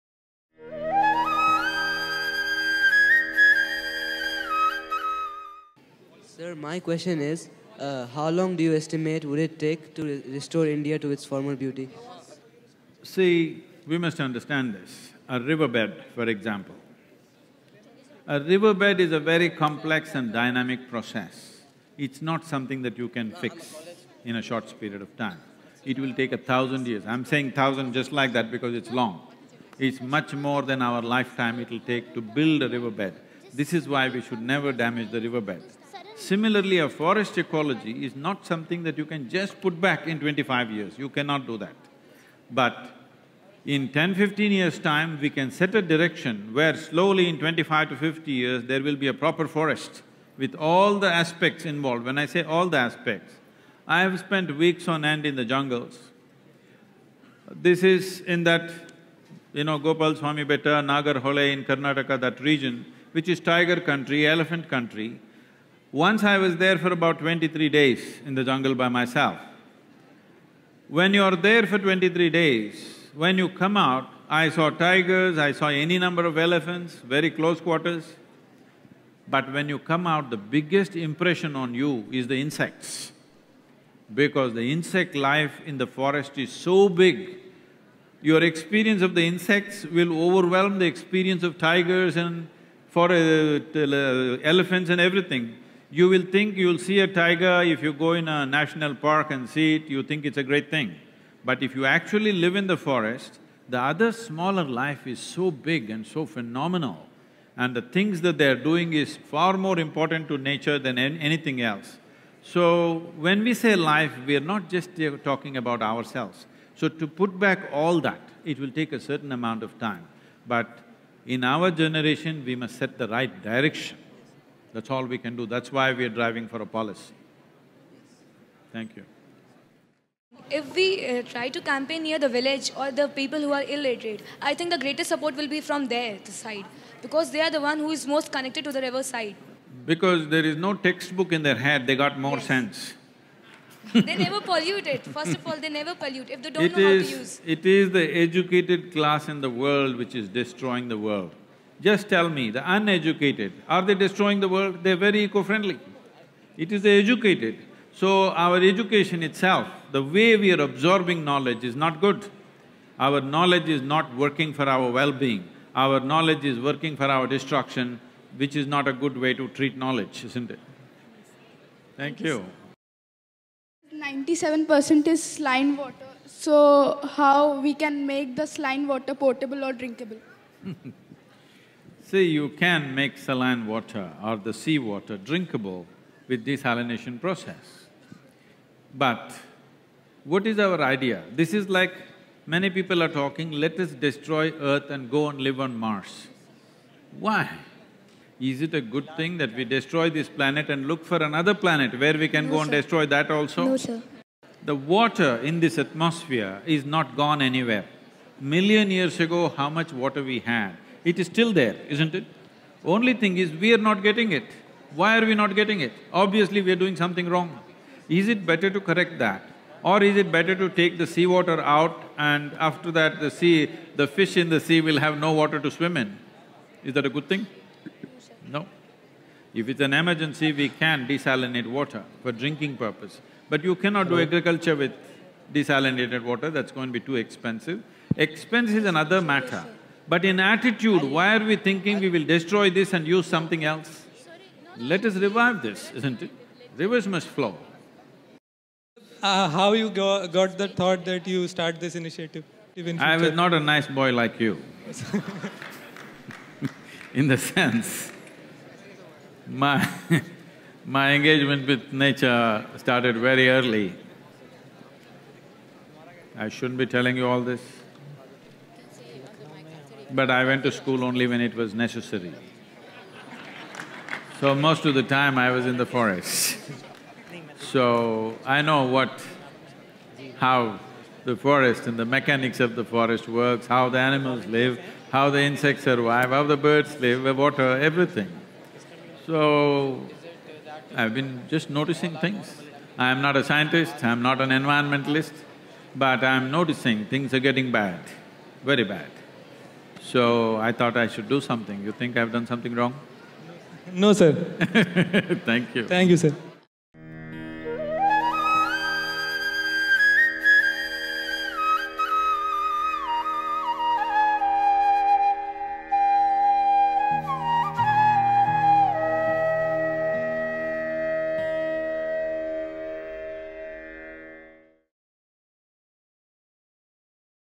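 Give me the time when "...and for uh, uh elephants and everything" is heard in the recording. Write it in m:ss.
1:32.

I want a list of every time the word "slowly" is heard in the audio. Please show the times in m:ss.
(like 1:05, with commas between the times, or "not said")
0:46.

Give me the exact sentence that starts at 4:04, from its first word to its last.
Let us revive this, isn't it?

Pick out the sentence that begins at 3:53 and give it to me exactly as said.
But you cannot do agriculture with desalinated water, that's going to be too expensive.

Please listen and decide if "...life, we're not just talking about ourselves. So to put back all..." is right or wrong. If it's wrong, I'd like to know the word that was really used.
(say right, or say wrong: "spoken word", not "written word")
right.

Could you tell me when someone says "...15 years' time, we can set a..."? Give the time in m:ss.
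0:44.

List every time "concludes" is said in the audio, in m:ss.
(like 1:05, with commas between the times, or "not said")
not said.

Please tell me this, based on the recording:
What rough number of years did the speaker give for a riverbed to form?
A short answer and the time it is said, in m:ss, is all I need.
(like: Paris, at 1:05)
1000 years, at 0:26.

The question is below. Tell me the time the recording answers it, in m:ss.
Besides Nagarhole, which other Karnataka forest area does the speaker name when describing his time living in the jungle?
0:59.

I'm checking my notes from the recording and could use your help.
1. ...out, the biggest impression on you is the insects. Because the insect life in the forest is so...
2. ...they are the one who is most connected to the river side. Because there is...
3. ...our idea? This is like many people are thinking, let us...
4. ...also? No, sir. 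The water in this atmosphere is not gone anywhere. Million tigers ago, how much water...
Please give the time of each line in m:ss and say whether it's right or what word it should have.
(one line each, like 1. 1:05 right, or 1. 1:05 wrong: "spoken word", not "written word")
1. 1:20 right
2. 2:17 right
3. 3:10 wrong: "talking", not "thinking"
4. 3:23 wrong: "years", not "tigers".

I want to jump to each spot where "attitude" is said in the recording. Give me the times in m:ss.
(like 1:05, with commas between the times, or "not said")
4:00.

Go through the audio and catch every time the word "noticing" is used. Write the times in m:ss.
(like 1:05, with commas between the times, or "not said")
4:51, 4:56.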